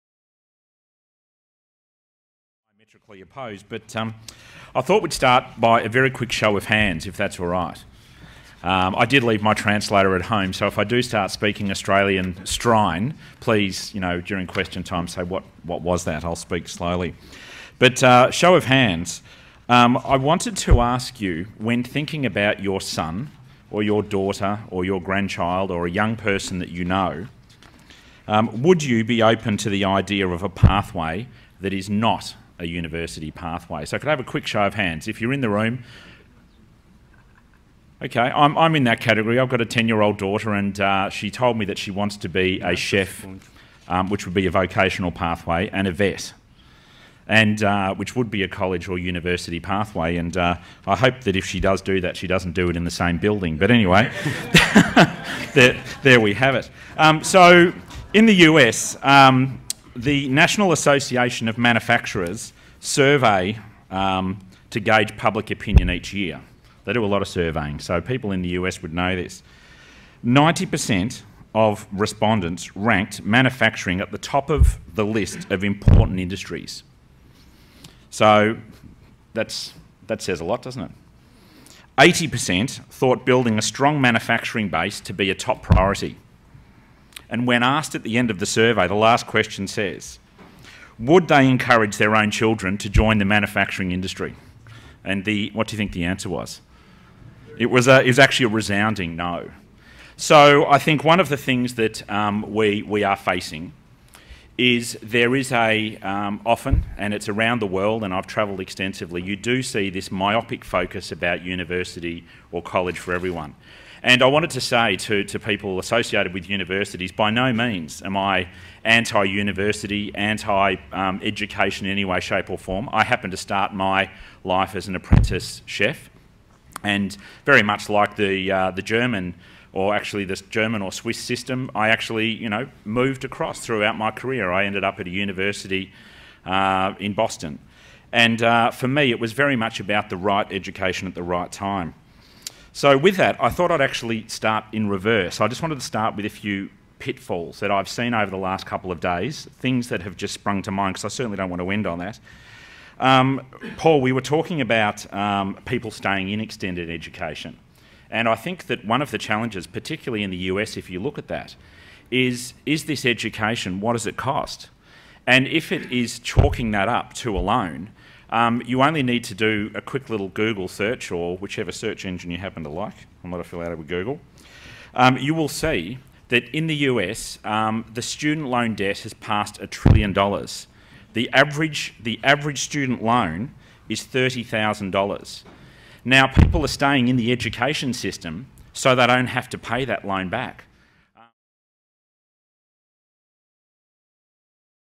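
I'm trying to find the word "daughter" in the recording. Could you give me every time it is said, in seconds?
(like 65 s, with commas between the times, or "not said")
24 s, 40 s.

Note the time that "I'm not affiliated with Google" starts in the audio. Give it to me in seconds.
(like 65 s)
173 s.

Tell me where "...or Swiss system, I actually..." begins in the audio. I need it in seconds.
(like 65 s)
130 s.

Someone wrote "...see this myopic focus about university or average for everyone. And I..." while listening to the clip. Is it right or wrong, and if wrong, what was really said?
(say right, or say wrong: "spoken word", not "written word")
wrong: "college", not "average".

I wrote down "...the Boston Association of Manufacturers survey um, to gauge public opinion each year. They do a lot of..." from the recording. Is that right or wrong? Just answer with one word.
wrong.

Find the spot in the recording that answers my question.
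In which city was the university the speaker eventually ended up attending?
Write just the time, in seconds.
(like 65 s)
137 s.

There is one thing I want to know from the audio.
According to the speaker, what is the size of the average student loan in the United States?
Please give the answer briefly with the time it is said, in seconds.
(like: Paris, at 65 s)
$30,000, at 184 s.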